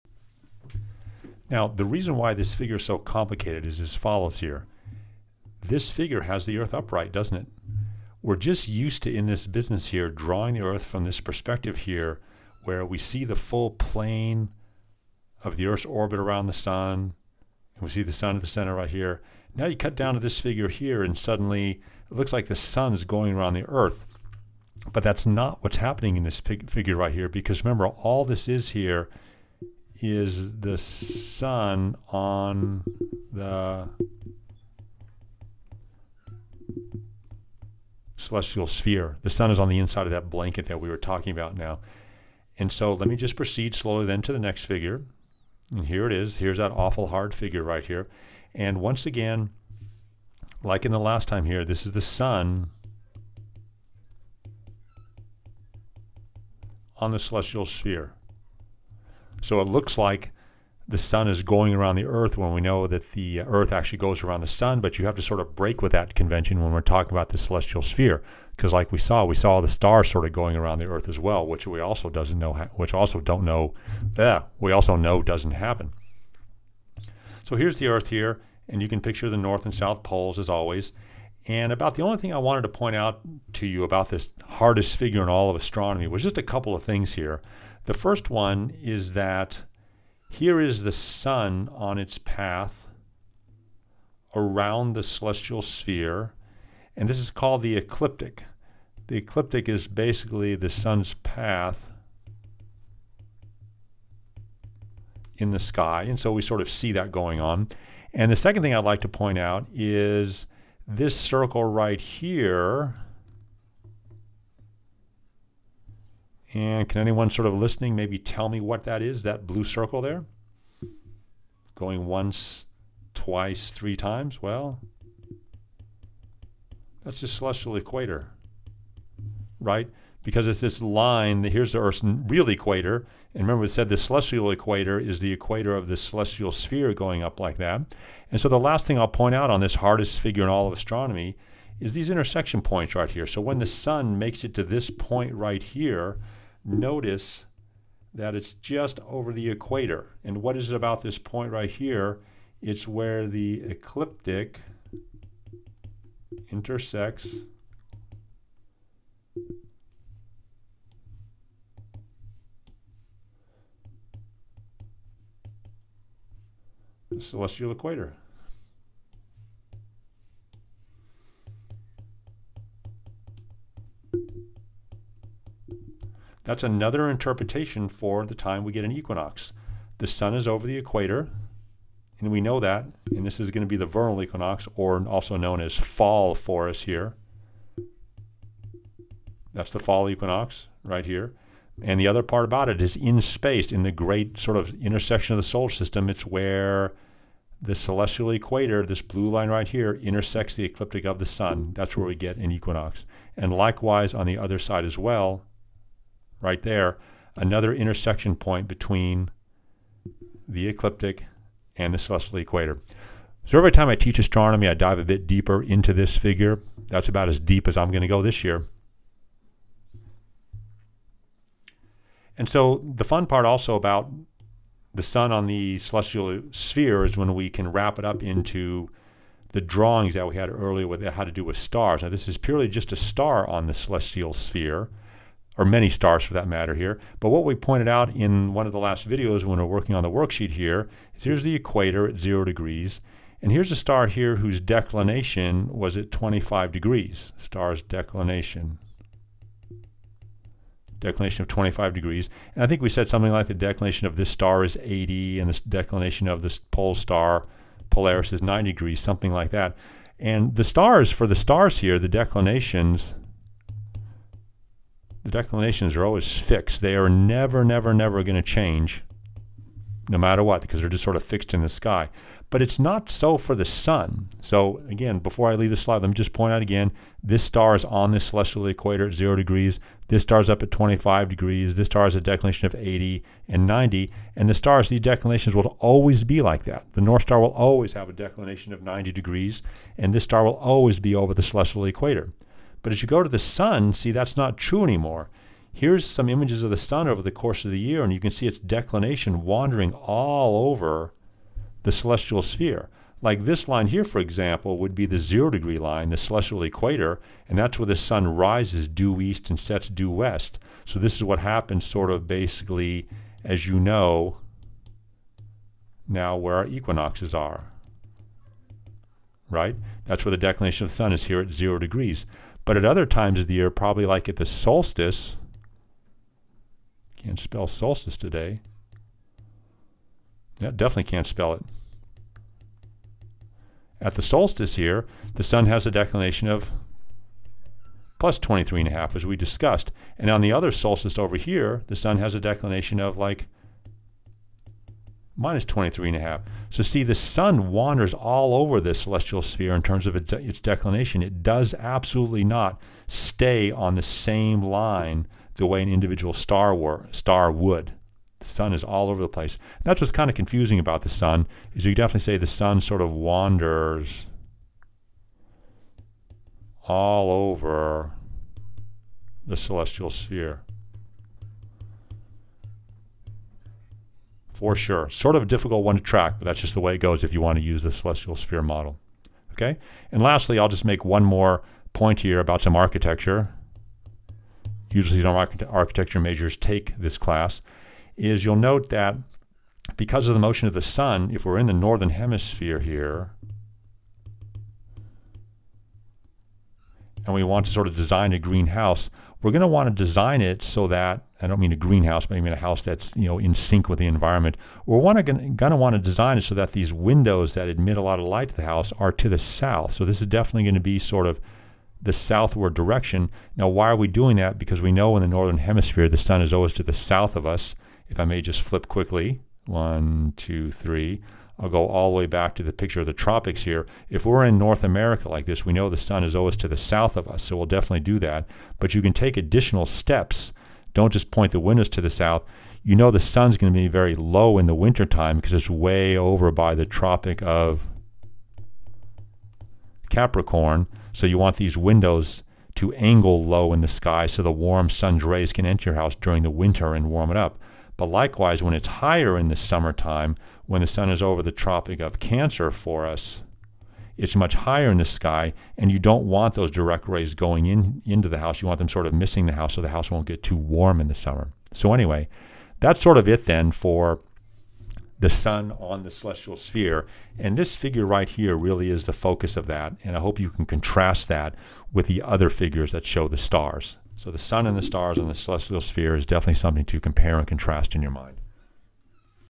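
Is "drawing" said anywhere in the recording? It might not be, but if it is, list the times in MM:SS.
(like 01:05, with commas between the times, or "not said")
00:10, 03:49.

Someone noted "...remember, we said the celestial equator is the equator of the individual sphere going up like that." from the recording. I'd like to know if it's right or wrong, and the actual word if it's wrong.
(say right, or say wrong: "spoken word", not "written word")
wrong: "celestial", not "individual".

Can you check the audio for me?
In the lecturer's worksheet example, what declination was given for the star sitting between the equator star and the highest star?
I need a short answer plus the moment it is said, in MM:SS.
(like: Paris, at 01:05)
25 degrees, at 04:04.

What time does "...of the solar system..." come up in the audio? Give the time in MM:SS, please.
03:15.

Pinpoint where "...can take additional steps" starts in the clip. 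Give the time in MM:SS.
07:09.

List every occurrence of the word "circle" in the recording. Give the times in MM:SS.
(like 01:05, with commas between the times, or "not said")
01:51, 01:59.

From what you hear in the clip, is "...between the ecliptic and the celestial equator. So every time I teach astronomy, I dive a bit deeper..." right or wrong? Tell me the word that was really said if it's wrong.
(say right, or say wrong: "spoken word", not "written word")
right.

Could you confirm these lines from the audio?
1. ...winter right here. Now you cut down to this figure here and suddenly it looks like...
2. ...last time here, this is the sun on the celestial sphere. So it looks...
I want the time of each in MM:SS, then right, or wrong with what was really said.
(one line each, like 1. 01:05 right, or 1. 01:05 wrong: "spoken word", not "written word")
1. 00:18 wrong: "center", not "winter"
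2. 00:50 right.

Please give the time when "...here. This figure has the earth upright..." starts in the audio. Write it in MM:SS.
00:04.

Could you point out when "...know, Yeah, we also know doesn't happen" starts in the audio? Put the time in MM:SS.
01:13.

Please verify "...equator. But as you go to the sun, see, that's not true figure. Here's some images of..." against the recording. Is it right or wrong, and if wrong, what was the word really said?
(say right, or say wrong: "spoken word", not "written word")
wrong: "anymore", not "figure".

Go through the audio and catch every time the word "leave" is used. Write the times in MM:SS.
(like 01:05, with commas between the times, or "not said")
04:35.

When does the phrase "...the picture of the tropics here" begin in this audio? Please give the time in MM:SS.
07:02.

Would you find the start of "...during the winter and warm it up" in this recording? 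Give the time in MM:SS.
07:26.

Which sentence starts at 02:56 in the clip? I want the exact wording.
That's another interpretation for the time we get an equinox.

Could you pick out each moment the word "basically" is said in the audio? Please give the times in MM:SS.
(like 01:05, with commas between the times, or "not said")
01:39, 05:12.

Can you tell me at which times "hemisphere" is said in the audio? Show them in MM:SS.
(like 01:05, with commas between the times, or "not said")
06:32, 06:55.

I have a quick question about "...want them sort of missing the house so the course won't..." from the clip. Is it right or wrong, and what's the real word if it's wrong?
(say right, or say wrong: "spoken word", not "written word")
wrong: "house", not "course".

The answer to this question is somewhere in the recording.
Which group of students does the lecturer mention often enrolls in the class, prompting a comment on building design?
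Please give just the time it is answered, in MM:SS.
06:25.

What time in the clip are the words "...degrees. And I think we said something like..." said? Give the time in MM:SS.
04:11.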